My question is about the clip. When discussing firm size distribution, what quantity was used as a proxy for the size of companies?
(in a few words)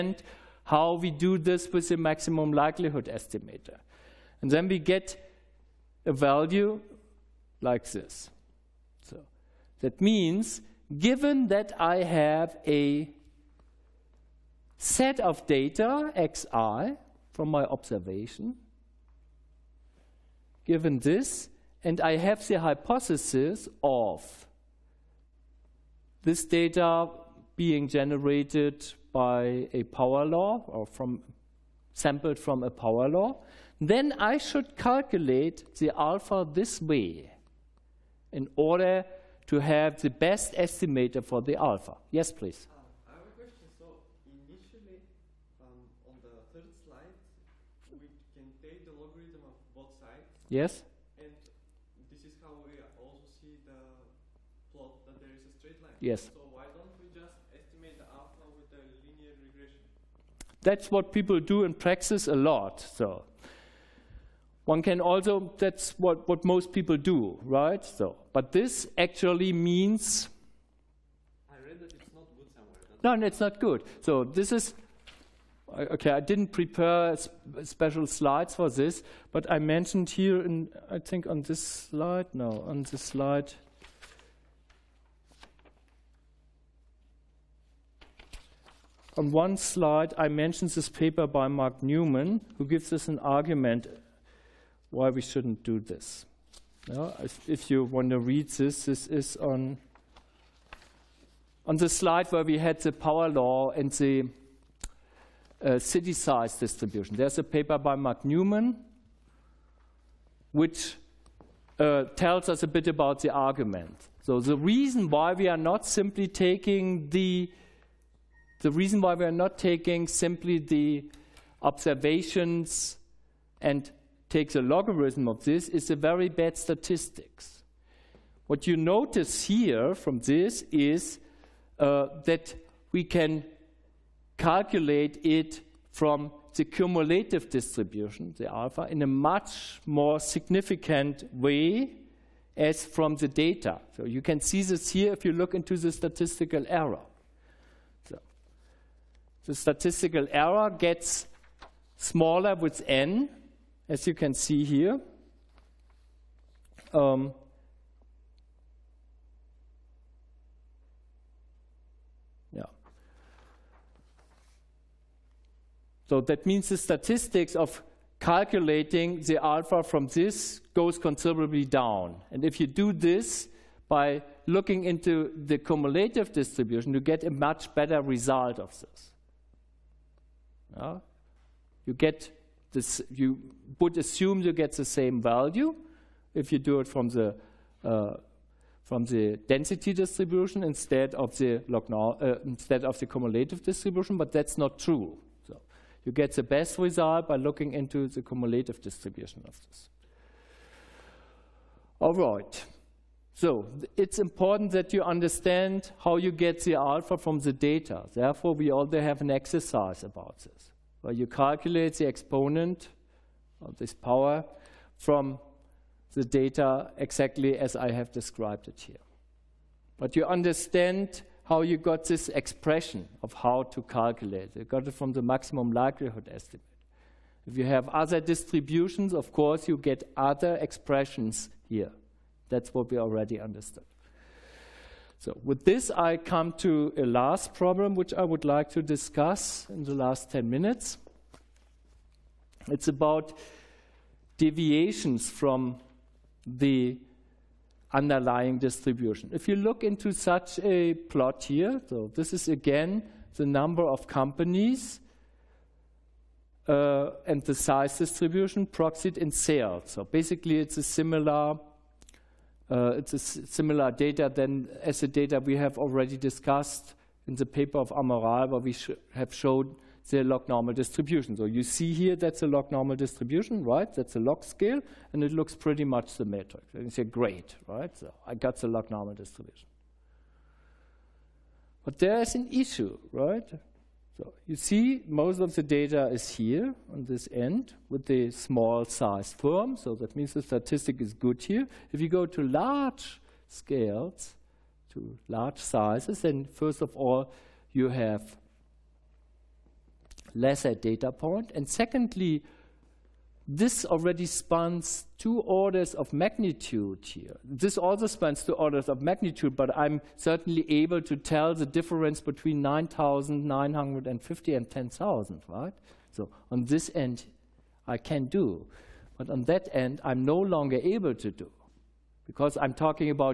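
Sales.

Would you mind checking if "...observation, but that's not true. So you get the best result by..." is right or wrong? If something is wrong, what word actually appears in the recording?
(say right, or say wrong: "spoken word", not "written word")
wrong: "distribution", not "observation".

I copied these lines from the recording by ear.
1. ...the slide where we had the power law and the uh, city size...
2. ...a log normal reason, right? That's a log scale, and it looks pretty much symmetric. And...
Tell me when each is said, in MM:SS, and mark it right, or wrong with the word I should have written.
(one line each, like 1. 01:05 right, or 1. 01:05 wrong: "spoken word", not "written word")
1. 01:41 right
2. 04:32 wrong: "distribution", not "reason".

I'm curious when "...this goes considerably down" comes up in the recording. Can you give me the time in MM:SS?
02:50.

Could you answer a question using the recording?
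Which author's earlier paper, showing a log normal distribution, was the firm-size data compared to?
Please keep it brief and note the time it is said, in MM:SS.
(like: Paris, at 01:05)
Amaral, at 04:27.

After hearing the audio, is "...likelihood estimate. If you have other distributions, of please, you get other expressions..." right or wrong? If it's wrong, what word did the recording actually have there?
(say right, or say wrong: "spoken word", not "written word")
wrong: "course", not "please".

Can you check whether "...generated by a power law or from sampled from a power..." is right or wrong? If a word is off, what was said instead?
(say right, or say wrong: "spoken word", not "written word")
right.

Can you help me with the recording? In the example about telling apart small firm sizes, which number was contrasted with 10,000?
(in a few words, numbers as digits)
9,950.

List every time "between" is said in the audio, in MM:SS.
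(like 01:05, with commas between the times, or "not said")
05:12.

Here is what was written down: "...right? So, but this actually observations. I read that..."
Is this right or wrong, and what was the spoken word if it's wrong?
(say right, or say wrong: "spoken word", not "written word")
wrong: "means", not "observations".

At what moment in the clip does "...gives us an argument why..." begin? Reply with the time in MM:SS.
01:32.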